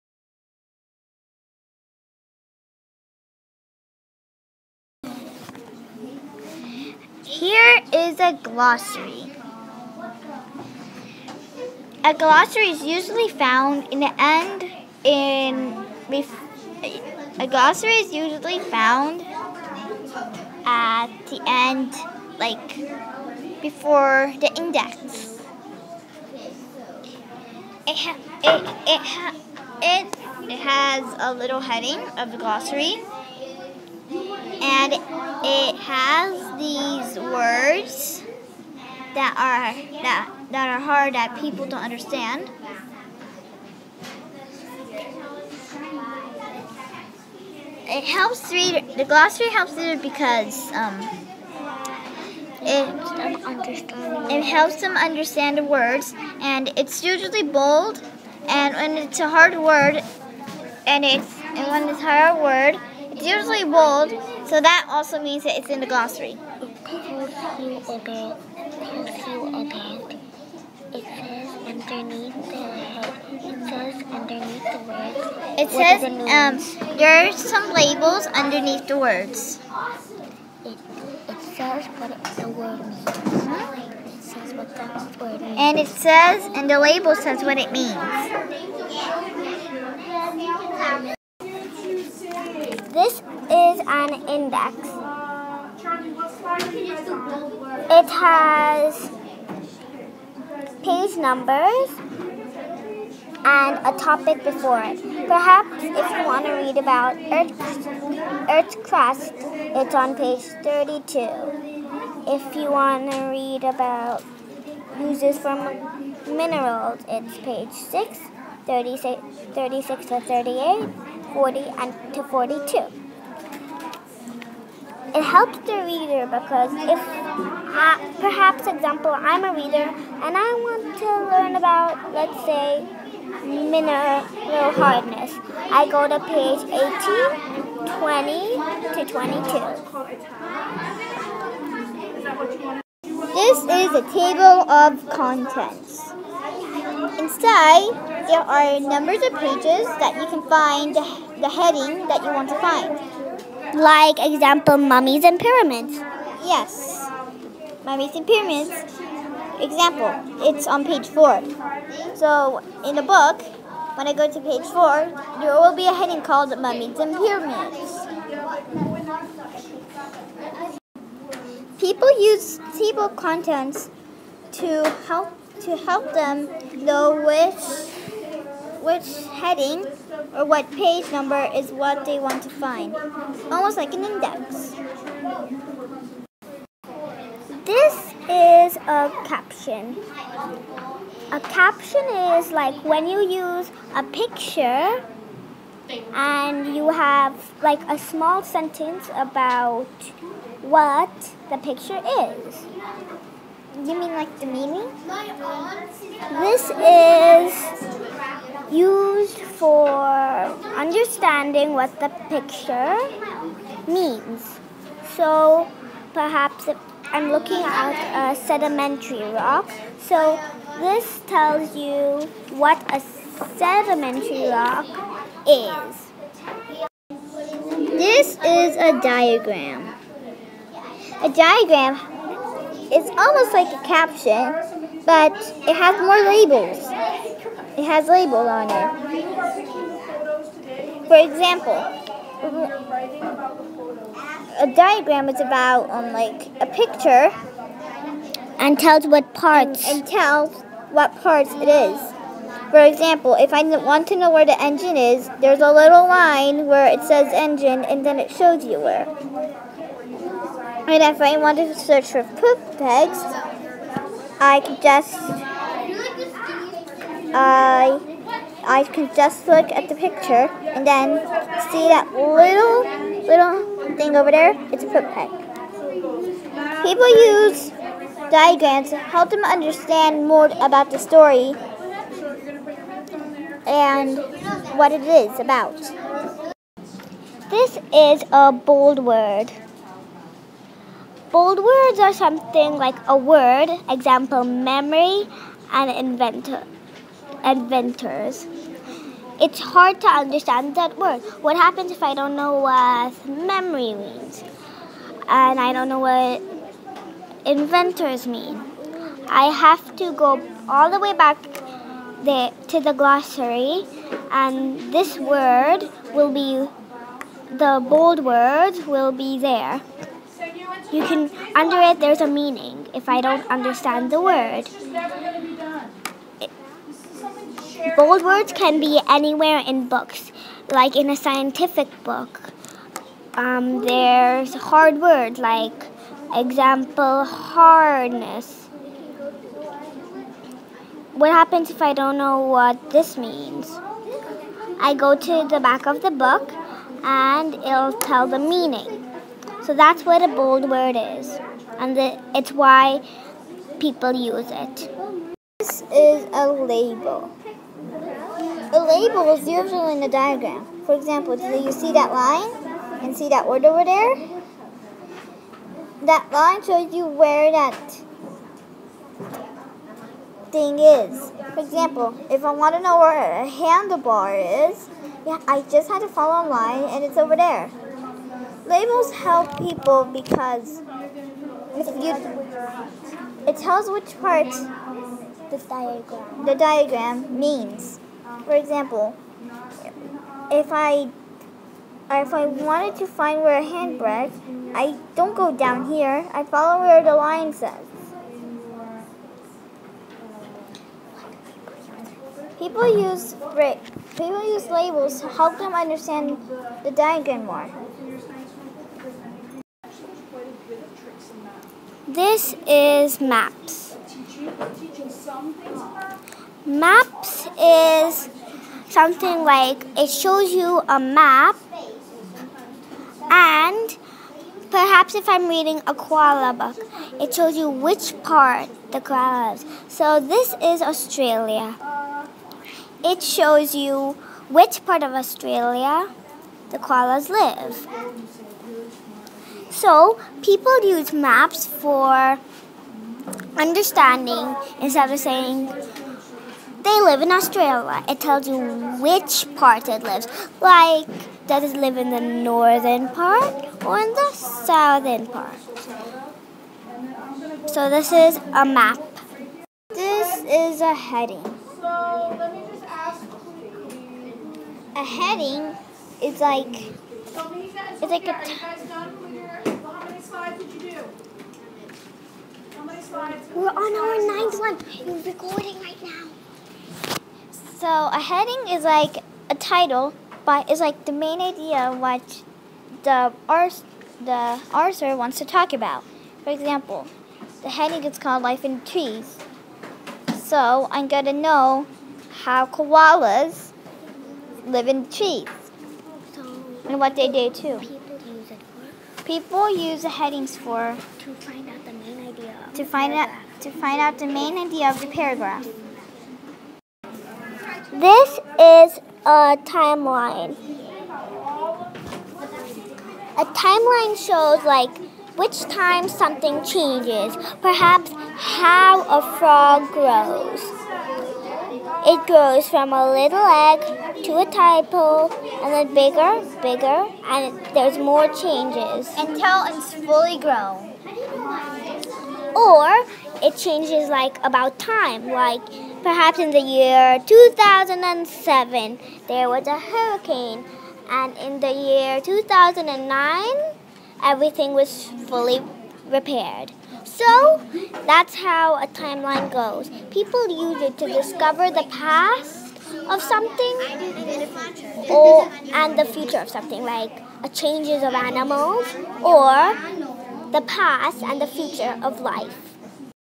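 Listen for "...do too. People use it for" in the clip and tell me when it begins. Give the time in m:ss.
8:17.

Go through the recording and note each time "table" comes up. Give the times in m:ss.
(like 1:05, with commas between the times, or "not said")
2:24, 2:52.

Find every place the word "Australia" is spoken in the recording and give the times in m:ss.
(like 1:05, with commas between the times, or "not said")
7:10, 7:15, 7:27.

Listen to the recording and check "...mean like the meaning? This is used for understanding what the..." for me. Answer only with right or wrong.
right.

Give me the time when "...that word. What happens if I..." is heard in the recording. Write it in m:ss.
5:00.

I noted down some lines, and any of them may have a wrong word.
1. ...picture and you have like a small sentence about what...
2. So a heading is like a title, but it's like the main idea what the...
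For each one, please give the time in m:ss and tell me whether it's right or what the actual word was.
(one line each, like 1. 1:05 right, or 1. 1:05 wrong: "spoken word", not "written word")
1. 3:14 right
2. 7:57 right.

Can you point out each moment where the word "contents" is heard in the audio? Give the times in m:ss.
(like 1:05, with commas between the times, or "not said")
2:25, 2:53.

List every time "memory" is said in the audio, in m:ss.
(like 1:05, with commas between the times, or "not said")
4:54, 5:03.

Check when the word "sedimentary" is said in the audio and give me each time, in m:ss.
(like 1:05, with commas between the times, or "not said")
3:38, 3:43.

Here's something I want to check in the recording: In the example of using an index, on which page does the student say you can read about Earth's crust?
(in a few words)
32.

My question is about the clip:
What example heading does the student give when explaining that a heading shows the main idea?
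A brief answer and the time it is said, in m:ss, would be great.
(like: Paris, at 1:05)
Life in Trees, at 8:08.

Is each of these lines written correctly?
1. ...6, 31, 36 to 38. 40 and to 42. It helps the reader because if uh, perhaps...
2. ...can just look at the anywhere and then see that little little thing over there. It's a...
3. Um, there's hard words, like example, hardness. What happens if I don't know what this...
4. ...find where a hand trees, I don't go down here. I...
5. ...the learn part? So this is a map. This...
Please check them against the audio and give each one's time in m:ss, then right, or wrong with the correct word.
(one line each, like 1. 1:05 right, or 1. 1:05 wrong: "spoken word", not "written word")
1. 1:57 wrong: "36", not "31"
2. 4:28 wrong: "picture", not "anywhere"
3. 5:33 right
4. 6:33 wrong: "brakes", not "trees"
5. 7:34 wrong: "southern", not "learn".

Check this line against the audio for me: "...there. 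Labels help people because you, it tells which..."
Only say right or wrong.
right.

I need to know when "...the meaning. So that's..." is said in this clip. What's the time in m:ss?
5:48.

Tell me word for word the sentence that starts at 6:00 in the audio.
For example, do you see that line and see that word over there?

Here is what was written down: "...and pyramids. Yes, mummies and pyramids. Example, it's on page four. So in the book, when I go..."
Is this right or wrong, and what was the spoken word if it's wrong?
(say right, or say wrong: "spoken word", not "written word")
right.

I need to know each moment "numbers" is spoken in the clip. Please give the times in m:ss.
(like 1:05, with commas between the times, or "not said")
1:41, 2:28, 3:01.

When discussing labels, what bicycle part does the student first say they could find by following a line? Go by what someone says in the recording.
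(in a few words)
Handlebar.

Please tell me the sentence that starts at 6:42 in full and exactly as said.
People use people use labels to help them understand the diagram more.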